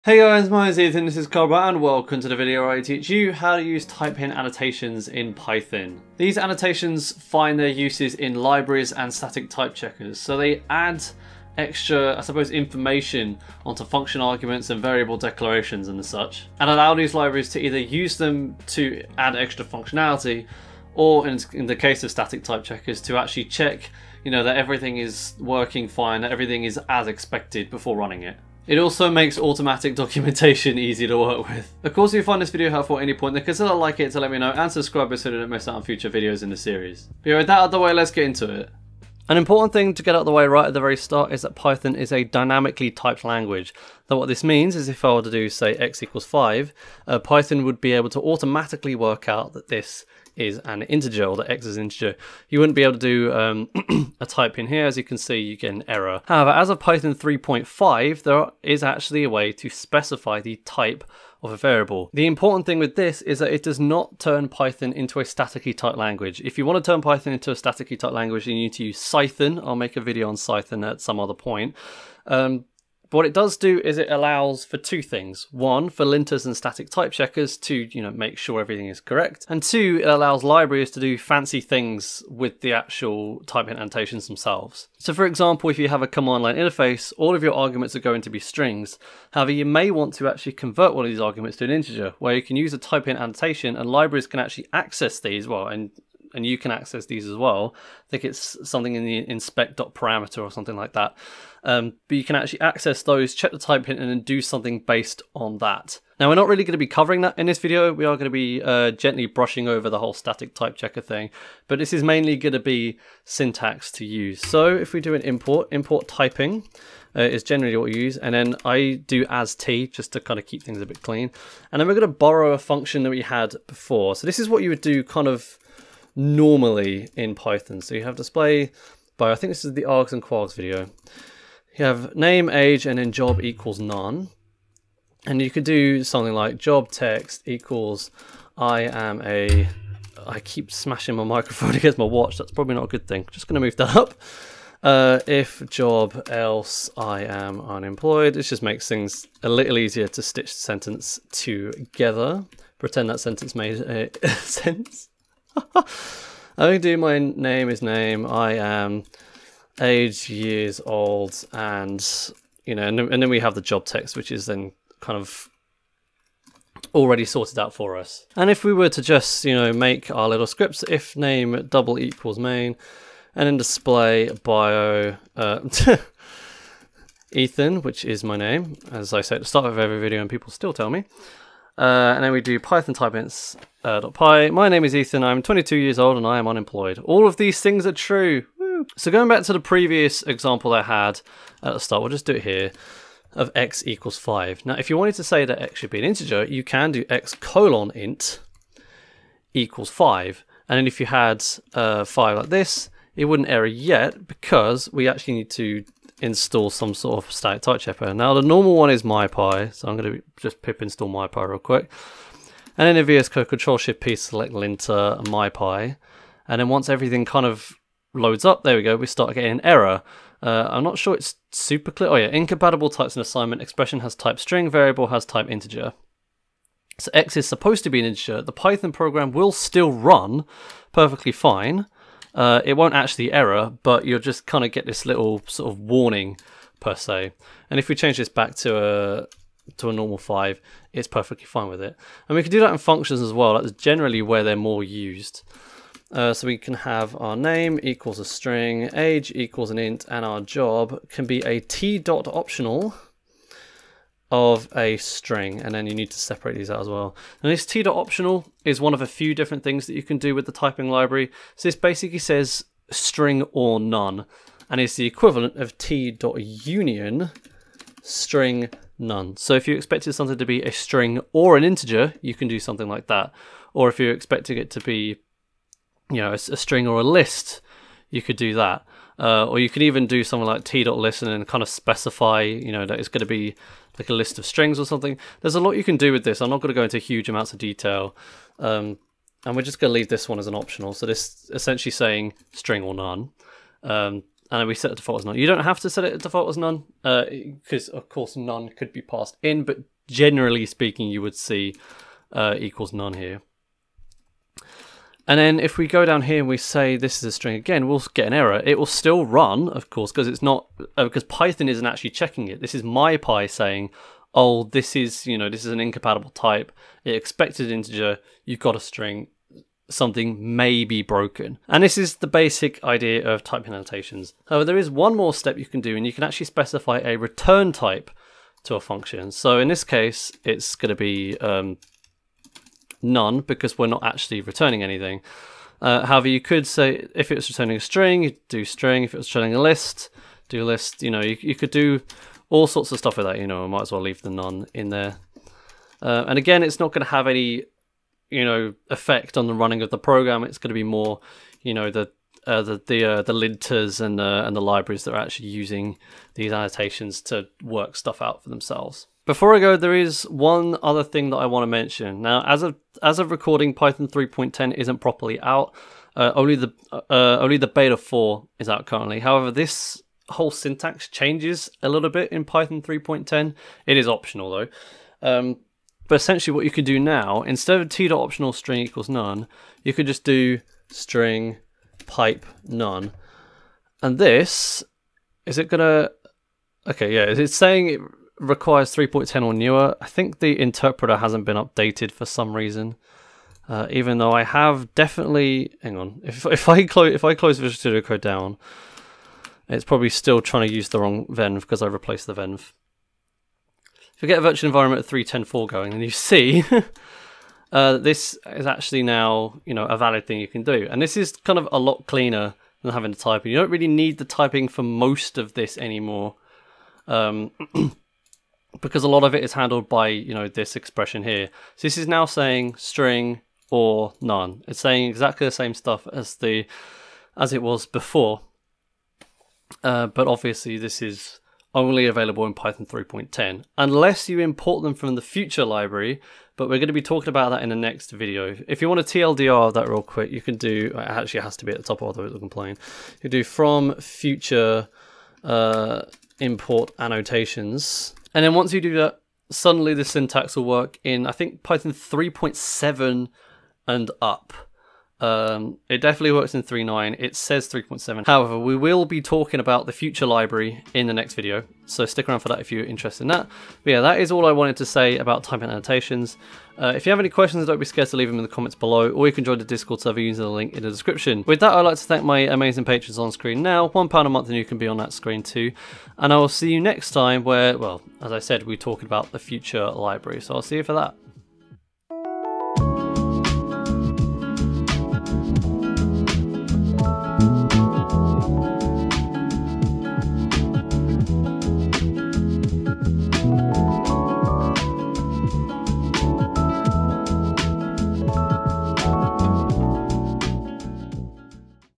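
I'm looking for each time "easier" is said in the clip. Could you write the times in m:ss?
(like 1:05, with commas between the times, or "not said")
2:29.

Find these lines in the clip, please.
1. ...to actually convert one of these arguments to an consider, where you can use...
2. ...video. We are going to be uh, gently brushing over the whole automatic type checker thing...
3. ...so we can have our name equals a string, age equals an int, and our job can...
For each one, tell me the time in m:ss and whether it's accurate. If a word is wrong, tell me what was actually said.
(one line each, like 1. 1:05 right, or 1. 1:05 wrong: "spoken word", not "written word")
1. 1:30 wrong: "integer", not "consider"
2. 1:47 wrong: "static", not "automatic"
3. 4:06 right.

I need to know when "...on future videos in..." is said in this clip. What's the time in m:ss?
0:35.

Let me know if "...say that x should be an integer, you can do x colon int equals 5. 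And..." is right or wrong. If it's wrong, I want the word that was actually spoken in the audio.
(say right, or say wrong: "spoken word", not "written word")
right.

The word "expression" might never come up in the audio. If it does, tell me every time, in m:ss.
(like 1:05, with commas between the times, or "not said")
3:43, 7:00.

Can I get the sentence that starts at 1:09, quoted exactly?
I'll make a video on Cython at some other point.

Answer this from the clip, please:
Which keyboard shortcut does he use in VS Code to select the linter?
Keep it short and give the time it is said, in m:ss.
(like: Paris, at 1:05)
Control Shift P, at 3:33.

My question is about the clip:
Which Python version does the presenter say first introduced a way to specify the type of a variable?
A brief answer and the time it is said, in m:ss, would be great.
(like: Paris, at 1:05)
Python 3.5, at 0:56.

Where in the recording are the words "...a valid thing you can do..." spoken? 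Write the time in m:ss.
6:49.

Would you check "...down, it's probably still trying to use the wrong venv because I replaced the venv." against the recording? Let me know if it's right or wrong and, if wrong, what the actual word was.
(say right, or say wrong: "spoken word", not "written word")
right.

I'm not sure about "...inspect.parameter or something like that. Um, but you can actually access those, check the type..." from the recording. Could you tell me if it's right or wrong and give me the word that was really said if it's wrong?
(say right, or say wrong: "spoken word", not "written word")
right.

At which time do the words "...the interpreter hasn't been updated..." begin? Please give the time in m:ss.
6:30.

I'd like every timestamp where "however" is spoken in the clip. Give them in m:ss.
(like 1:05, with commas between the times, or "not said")
0:56, 1:29, 5:24, 5:36, 6:09, 7:38.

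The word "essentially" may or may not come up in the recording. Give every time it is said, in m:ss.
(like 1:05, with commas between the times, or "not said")
4:51, 6:16.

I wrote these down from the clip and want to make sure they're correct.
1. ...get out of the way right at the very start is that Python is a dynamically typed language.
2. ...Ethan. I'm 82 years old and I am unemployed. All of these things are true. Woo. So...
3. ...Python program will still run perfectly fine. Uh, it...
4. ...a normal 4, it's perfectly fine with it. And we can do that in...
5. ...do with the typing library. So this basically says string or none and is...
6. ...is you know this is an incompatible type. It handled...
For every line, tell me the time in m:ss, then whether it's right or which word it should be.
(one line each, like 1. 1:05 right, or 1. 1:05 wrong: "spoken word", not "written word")
1. 0:40 right
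2. 3:04 wrong: "22", not "82"
3. 3:48 right
4. 3:59 wrong: "5", not "4"
5. 4:20 right
6. 5:14 wrong: "expected", not "handled".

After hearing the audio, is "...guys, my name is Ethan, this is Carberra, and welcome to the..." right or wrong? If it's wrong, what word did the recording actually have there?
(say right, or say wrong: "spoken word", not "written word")
right.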